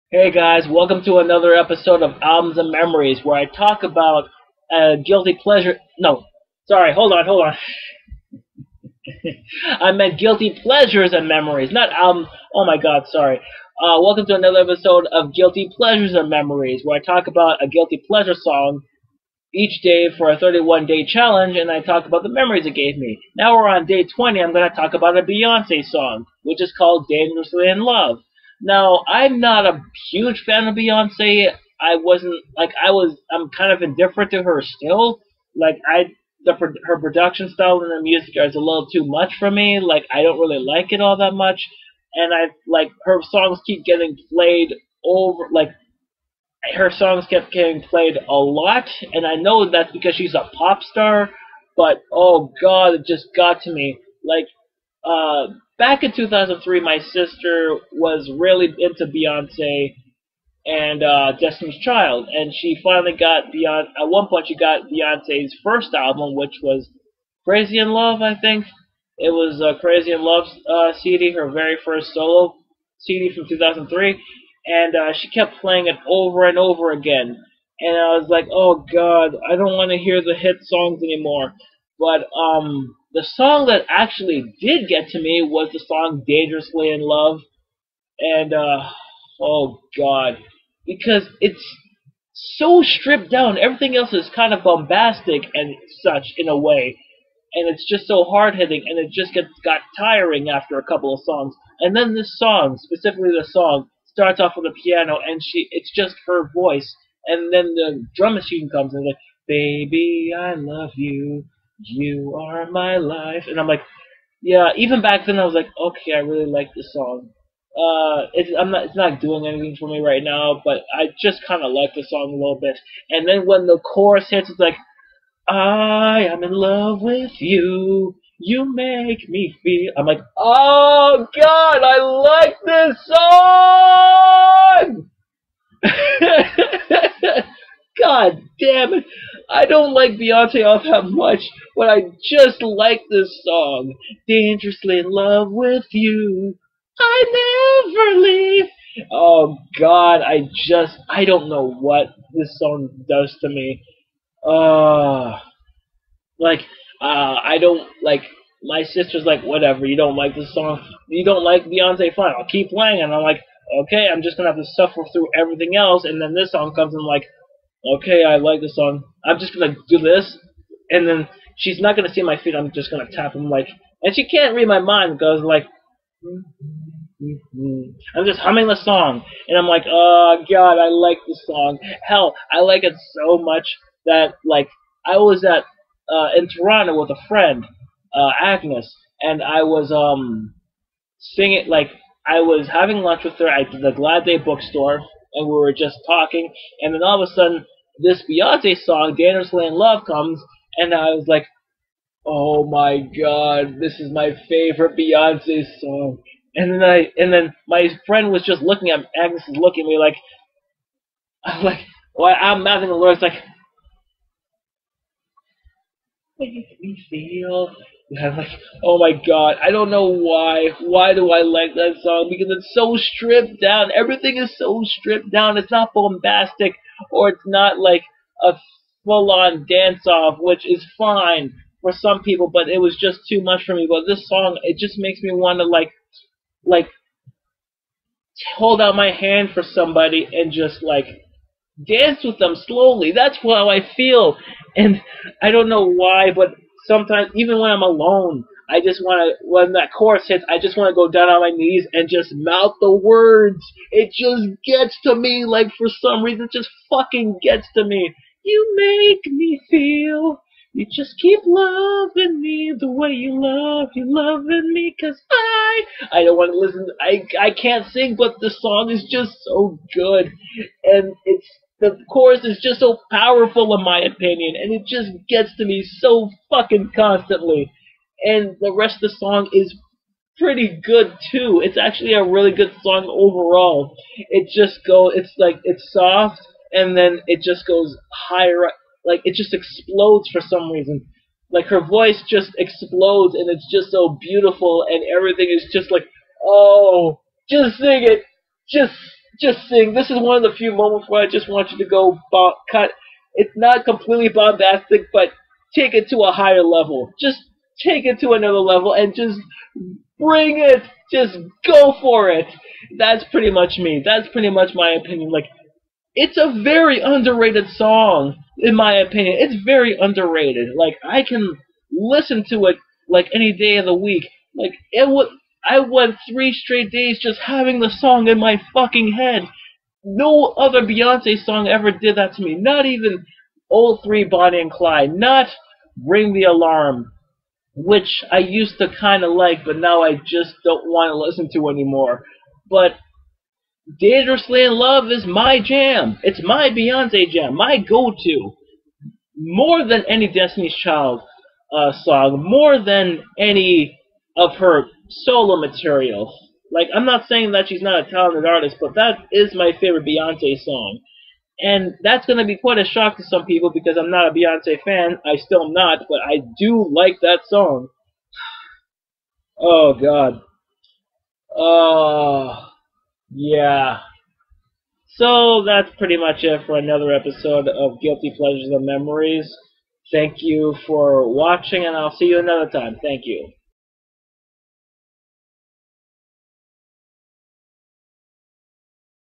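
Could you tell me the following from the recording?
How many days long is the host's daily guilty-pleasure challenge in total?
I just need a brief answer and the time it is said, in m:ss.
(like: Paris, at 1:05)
31, at 0:20.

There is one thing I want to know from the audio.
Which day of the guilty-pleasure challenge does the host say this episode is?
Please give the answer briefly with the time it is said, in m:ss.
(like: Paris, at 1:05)
20, at 0:24.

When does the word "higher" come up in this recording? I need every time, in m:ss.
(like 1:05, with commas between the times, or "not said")
4:48, 5:06.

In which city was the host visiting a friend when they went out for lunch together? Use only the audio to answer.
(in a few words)
Toronto.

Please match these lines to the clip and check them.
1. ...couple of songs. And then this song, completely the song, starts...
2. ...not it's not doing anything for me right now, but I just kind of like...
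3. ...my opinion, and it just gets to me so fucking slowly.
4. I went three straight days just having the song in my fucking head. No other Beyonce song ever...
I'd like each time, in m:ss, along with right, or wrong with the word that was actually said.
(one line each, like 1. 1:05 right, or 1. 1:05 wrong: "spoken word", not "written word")
1. 1:40 wrong: "specifically", not "completely"
2. 1:58 right
3. 4:33 wrong: "constantly", not "slowly"
4. 5:25 right.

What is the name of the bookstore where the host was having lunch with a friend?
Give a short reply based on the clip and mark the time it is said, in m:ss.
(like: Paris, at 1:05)
Glad Day, at 3:13.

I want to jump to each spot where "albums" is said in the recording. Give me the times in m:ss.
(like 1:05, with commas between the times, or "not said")
0:02, 0:11, 1:05.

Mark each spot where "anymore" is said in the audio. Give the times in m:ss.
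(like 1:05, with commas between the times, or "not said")
1:21, 5:41.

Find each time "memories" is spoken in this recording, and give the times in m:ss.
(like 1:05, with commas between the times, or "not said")
0:02, 0:11, 0:16, 0:22, 6:18.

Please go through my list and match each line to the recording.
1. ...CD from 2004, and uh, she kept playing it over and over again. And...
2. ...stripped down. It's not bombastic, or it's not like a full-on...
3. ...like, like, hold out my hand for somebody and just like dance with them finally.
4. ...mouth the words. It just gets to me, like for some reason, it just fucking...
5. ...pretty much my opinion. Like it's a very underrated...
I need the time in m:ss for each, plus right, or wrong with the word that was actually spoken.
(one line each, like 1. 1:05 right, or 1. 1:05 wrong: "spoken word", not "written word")
1. 1:12 wrong: "2003", not "2004"
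2. 3:44 right
3. 3:55 wrong: "slowly", not "finally"
4. 4:12 right
5. 5:14 right.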